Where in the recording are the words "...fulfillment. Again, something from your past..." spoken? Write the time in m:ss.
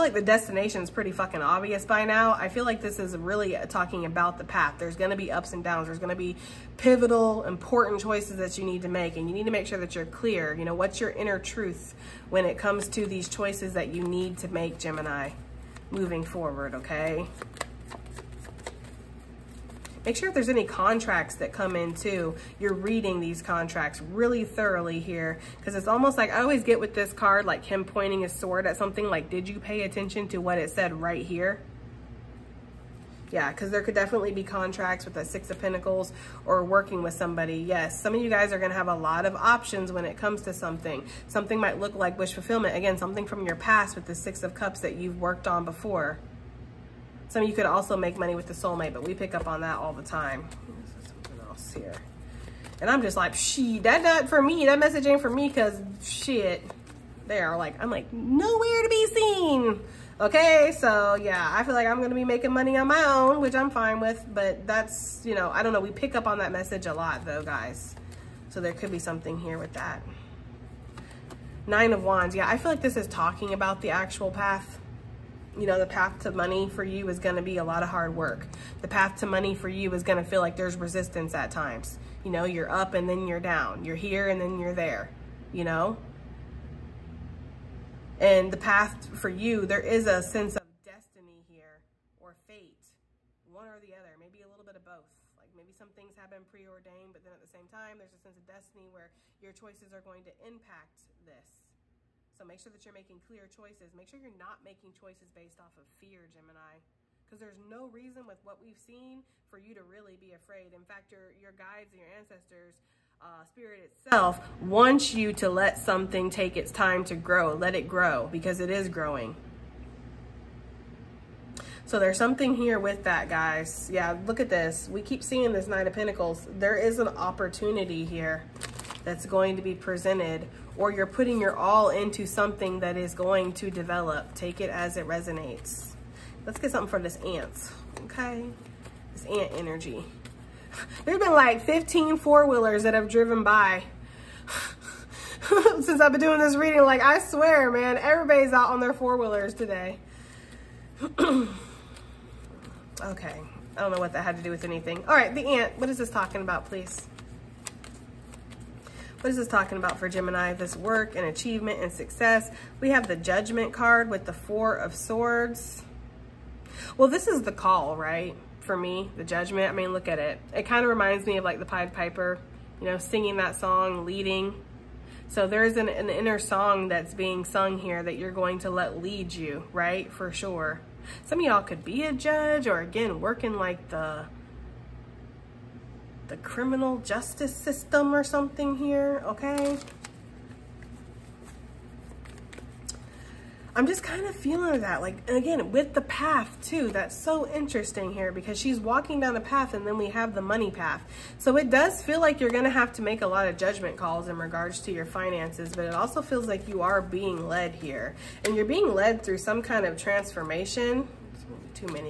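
0:42.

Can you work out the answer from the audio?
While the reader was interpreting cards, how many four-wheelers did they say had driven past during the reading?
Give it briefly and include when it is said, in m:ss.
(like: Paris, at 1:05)
15, at 2:21.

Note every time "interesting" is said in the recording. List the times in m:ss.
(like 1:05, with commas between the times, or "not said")
3:17.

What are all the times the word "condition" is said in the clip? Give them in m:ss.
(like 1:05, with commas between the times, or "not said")
not said.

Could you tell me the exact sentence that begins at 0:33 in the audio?
Yeah, because there could definitely be contracts with a Six of Pentacles or working with somebody.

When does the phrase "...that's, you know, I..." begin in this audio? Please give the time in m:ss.
1:04.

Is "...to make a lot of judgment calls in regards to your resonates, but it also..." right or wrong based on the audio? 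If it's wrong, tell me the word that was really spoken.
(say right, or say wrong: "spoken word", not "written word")
wrong: "finances", not "resonates".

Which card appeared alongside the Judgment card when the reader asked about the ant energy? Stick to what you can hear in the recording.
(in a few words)
Four of Swords.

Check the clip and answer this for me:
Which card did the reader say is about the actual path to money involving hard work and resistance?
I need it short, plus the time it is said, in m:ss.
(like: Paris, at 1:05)
Nine of Wands, at 1:11.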